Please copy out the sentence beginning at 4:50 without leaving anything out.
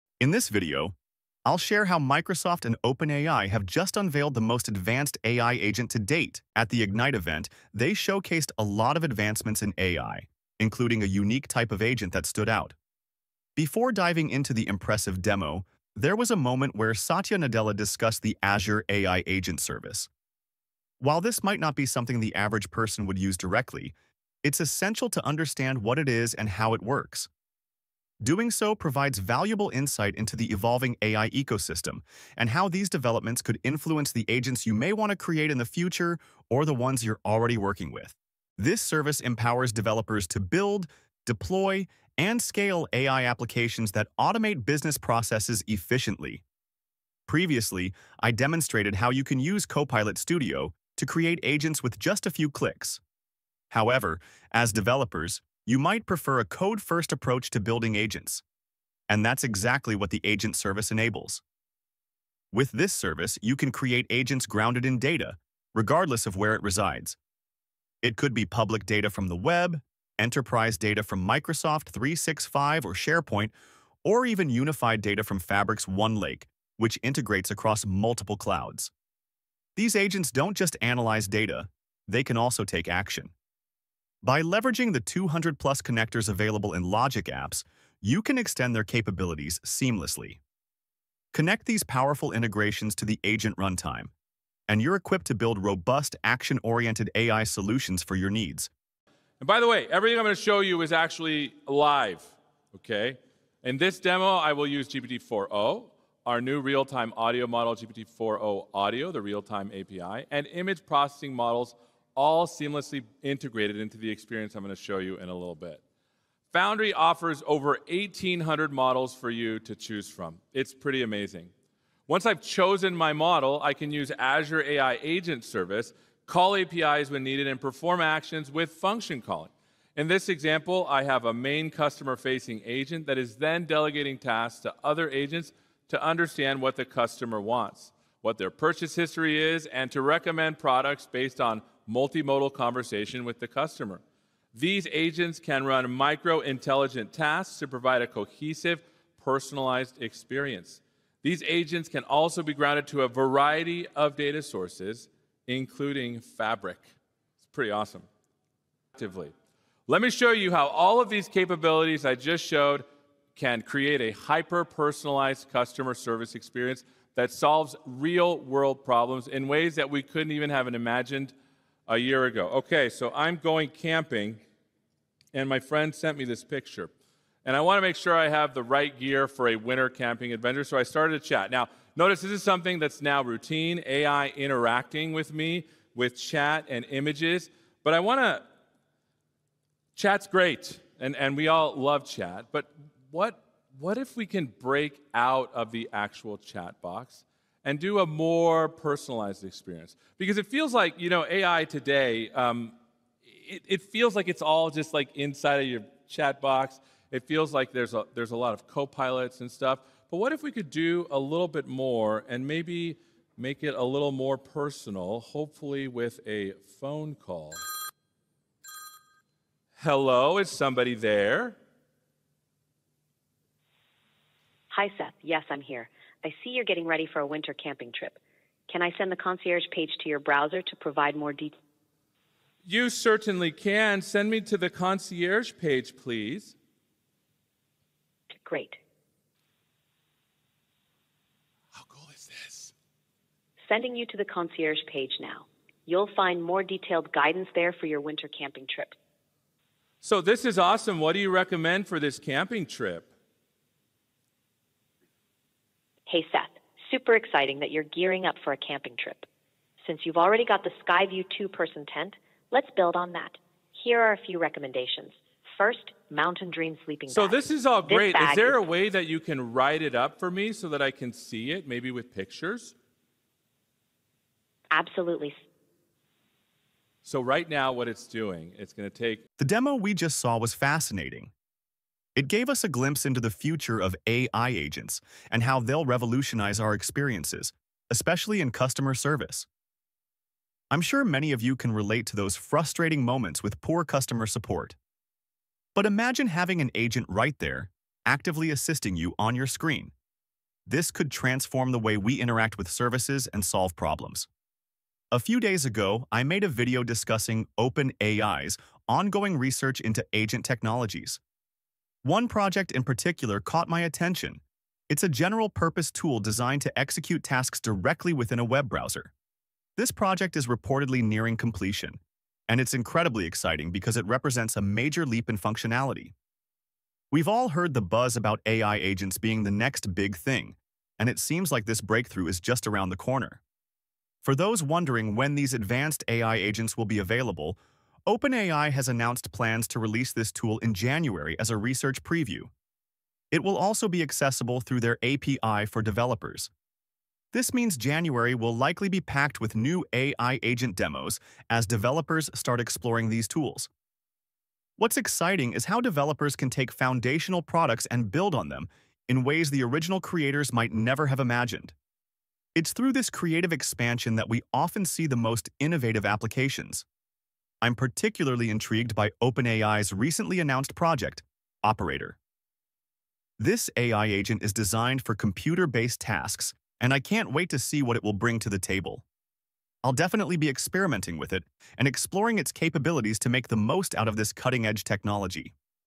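I'm sure many of you can relate to those frustrating moments with poor customer support.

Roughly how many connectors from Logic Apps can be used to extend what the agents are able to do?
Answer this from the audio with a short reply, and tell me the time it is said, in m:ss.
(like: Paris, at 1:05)
200-plus, at 1:25.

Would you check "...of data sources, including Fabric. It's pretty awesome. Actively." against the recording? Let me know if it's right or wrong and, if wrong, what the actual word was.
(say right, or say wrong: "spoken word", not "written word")
right.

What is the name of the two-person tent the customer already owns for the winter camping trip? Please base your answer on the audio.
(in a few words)
Skyview.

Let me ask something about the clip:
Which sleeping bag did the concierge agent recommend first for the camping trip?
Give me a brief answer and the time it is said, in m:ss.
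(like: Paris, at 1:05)
Mountain Dream, at 4:26.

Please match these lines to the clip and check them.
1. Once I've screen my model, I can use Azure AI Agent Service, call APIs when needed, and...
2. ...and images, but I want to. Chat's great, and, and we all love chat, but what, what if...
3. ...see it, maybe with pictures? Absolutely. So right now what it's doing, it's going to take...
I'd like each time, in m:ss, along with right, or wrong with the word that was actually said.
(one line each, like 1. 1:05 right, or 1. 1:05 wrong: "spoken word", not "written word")
1. 2:02 wrong: "chosen", not "screen"
2. 3:06 right
3. 4:31 right.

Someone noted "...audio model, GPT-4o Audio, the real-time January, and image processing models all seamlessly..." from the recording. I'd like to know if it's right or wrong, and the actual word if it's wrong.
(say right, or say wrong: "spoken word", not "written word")
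wrong: "API", not "January".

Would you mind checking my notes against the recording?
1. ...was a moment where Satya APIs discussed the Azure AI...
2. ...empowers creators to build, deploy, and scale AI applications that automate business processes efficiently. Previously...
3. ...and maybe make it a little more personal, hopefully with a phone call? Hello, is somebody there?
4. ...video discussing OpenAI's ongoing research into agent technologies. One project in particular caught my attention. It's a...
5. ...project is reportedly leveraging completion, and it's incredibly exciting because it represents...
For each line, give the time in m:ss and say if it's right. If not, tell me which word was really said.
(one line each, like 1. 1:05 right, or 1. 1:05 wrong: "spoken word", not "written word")
1. 0:16 wrong: "Nadella", not "APIs"
2. 0:39 wrong: "developers", not "creators"
3. 3:32 right
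4. 5:06 right
5. 5:19 wrong: "nearing", not "leveraging".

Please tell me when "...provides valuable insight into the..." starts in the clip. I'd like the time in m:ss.
0:28.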